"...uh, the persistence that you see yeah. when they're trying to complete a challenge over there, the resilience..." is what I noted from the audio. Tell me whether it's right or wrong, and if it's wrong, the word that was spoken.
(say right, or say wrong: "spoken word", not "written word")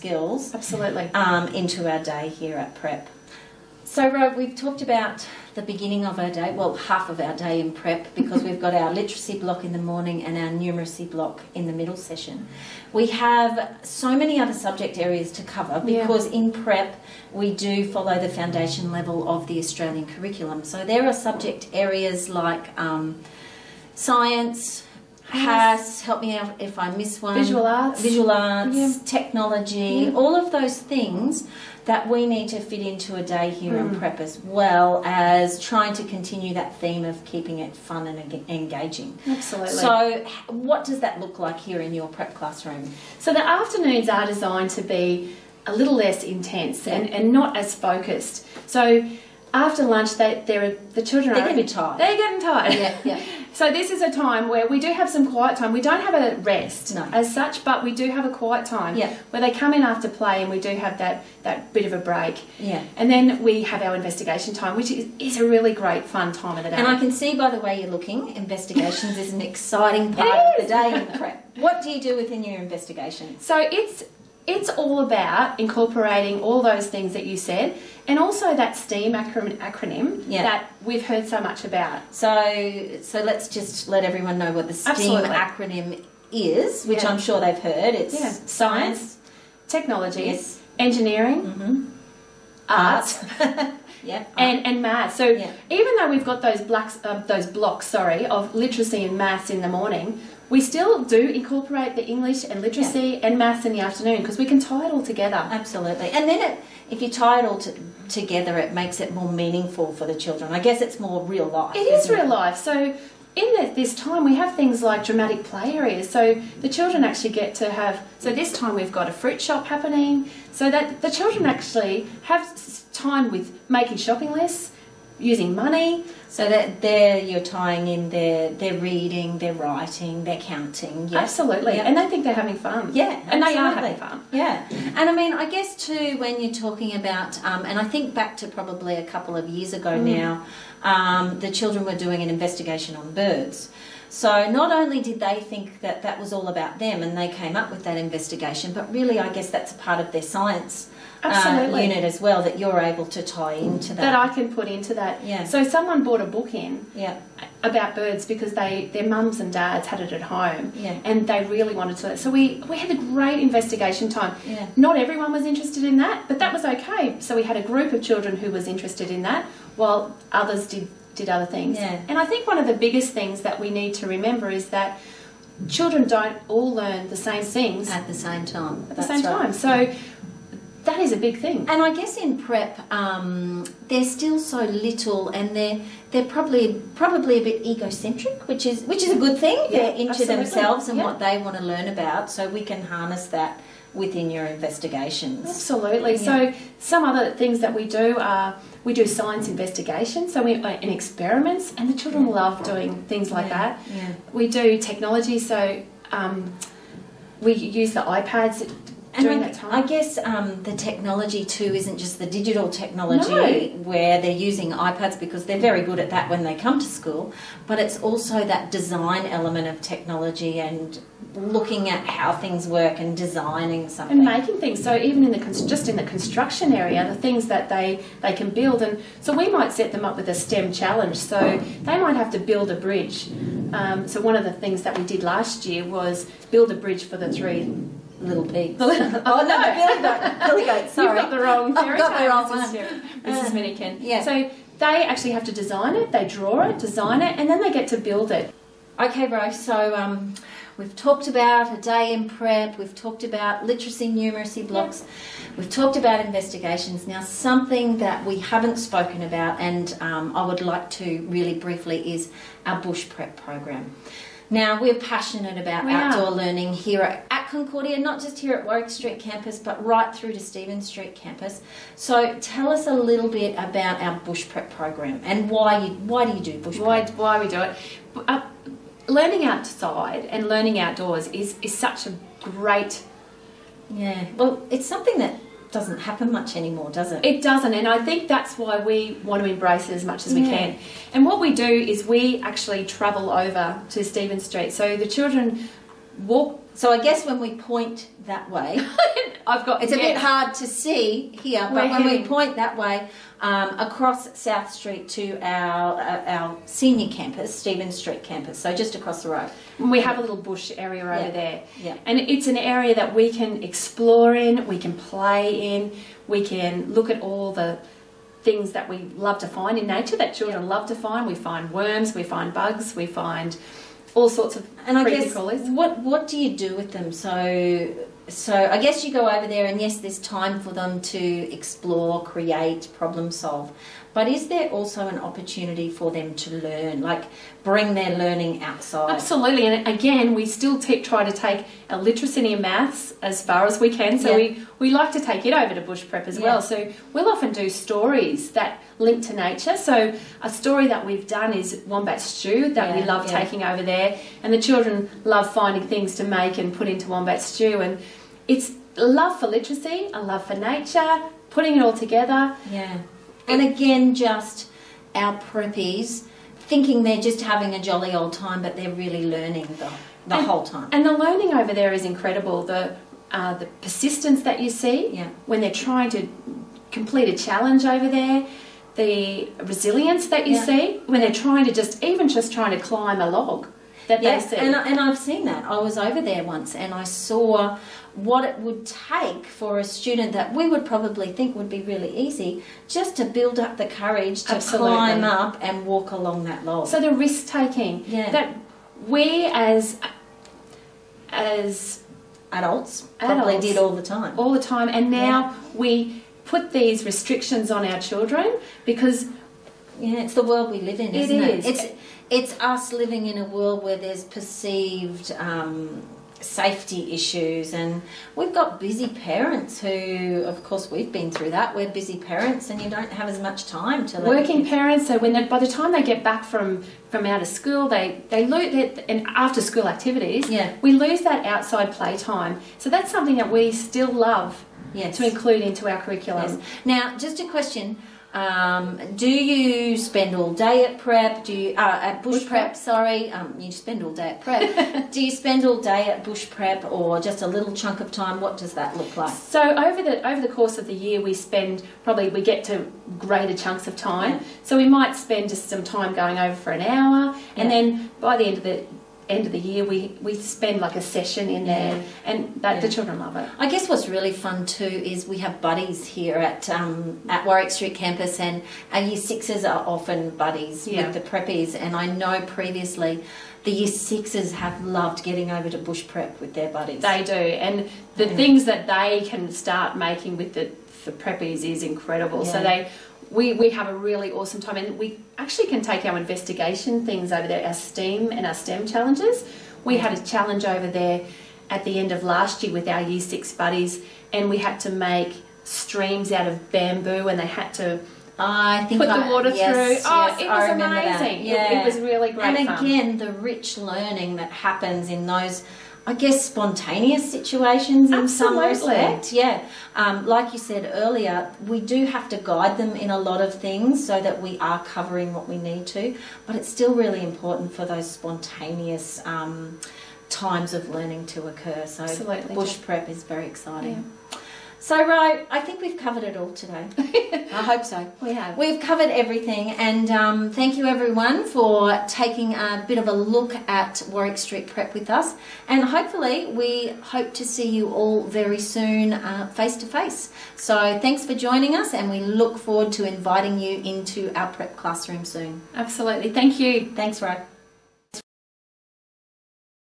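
right.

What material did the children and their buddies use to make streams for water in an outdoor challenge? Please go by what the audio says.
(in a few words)
Bamboo.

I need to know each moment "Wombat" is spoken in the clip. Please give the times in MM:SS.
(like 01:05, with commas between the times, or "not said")
05:51, 05:57.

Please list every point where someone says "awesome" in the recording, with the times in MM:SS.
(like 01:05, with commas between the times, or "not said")
08:04.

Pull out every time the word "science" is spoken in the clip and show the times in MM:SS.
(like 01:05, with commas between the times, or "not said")
00:23, 01:28, 02:30, 03:19.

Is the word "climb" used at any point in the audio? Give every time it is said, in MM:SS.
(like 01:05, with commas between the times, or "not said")
06:22, 06:34.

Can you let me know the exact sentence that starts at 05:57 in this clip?
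And it's love for literacy, a love for nature, putting it all together.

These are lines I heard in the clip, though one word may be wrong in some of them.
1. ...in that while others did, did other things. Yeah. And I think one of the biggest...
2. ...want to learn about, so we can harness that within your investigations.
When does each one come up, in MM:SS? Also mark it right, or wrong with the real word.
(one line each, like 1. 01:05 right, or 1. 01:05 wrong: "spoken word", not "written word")
1. 02:49 right
2. 03:11 right.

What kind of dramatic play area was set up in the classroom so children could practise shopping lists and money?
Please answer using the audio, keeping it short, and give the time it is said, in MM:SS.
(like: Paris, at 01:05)
A fruit shop, at 01:59.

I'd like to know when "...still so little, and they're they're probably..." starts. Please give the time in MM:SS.
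03:04.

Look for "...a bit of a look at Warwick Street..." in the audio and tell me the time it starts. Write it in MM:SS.
08:52.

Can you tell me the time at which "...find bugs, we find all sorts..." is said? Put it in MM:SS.
05:22.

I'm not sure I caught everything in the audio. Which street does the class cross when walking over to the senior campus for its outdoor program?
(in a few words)
South Street.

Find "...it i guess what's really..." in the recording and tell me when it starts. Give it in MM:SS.
07:43.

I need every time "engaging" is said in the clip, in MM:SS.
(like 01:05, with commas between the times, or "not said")
00:38.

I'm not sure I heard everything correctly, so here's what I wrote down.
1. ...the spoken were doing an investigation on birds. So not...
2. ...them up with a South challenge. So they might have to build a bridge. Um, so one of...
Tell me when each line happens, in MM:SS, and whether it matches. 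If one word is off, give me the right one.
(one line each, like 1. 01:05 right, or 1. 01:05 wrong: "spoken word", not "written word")
1. 02:21 wrong: "children", not "spoken"
2. 03:49 wrong: "STEM", not "South".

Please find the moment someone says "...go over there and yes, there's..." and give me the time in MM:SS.
05:29.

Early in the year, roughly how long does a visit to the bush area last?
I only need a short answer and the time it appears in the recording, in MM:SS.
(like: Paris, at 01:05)
An hour, at 07:36.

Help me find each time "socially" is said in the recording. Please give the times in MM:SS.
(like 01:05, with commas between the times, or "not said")
not said.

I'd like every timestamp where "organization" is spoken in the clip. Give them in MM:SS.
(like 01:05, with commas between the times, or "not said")
not said.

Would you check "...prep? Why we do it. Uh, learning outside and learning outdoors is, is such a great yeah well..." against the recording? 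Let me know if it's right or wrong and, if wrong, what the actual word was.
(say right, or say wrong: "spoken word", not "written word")
right.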